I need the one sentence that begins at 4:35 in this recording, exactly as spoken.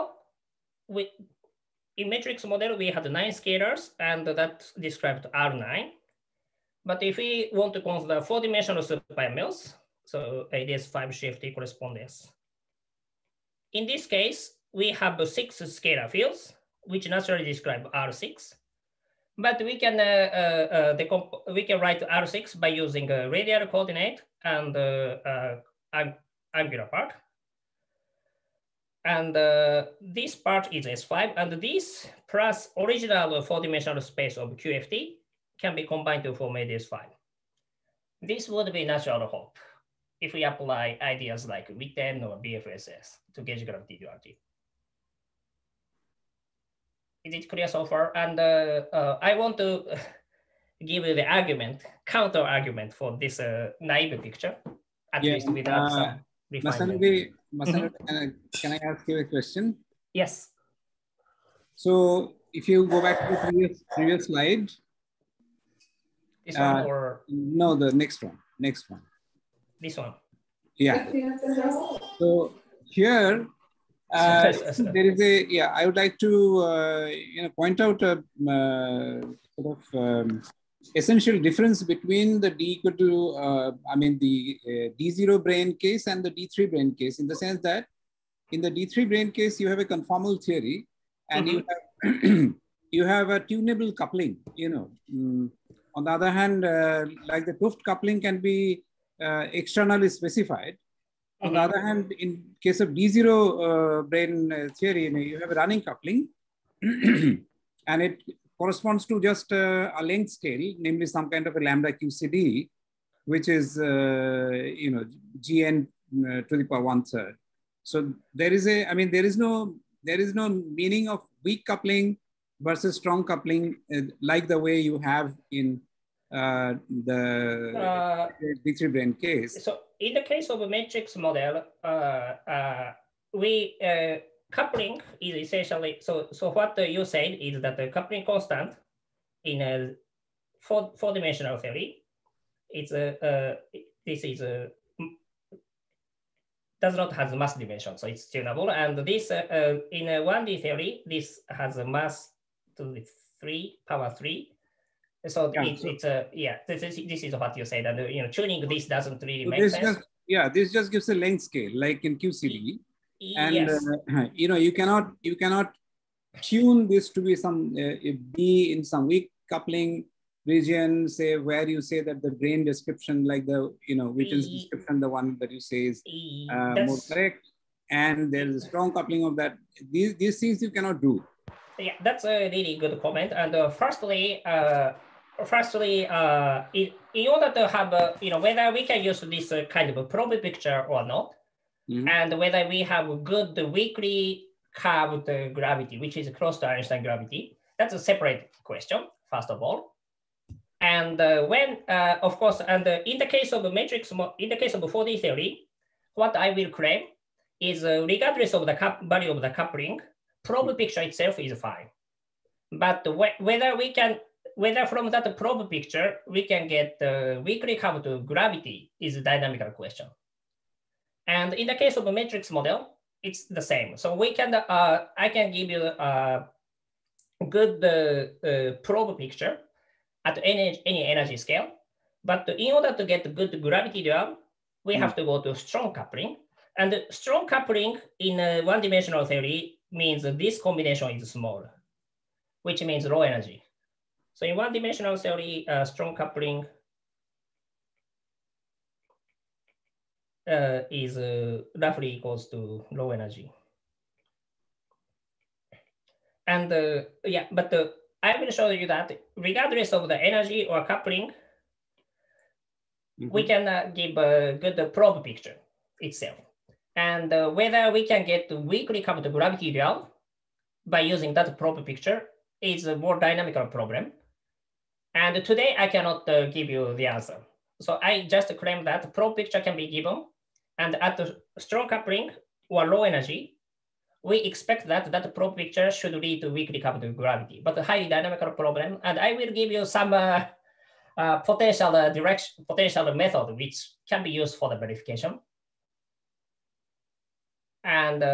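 And today I cannot uh, give you the answer.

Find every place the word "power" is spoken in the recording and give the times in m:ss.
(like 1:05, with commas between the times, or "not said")
1:56, 2:33.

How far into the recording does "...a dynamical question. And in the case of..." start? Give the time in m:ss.
3:39.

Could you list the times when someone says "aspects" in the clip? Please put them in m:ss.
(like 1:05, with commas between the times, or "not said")
not said.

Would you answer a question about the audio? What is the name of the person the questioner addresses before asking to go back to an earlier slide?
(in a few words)
Masanori.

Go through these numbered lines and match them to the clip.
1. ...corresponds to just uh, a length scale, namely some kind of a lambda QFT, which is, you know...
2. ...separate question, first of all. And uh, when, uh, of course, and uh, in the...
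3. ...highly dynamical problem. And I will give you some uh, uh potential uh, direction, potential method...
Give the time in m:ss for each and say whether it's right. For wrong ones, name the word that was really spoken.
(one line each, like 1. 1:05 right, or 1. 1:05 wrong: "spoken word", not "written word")
1. 1:48 wrong: "QCD", not "QFT"
2. 3:17 right
3. 4:47 right.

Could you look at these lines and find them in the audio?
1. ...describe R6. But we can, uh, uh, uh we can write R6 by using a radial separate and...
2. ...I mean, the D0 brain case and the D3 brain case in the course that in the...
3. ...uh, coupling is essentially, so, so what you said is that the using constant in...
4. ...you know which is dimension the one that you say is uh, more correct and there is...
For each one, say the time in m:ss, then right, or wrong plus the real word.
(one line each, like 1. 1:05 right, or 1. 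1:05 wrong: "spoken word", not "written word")
1. 0:17 wrong: "coordinate", not "separate"
2. 1:23 wrong: "sense", not "course"
3. 2:13 wrong: "coupling", not "using"
4. 2:53 wrong: "description", not "dimension".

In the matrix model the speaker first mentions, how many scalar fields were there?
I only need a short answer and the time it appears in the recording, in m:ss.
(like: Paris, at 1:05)
9, at 0:03.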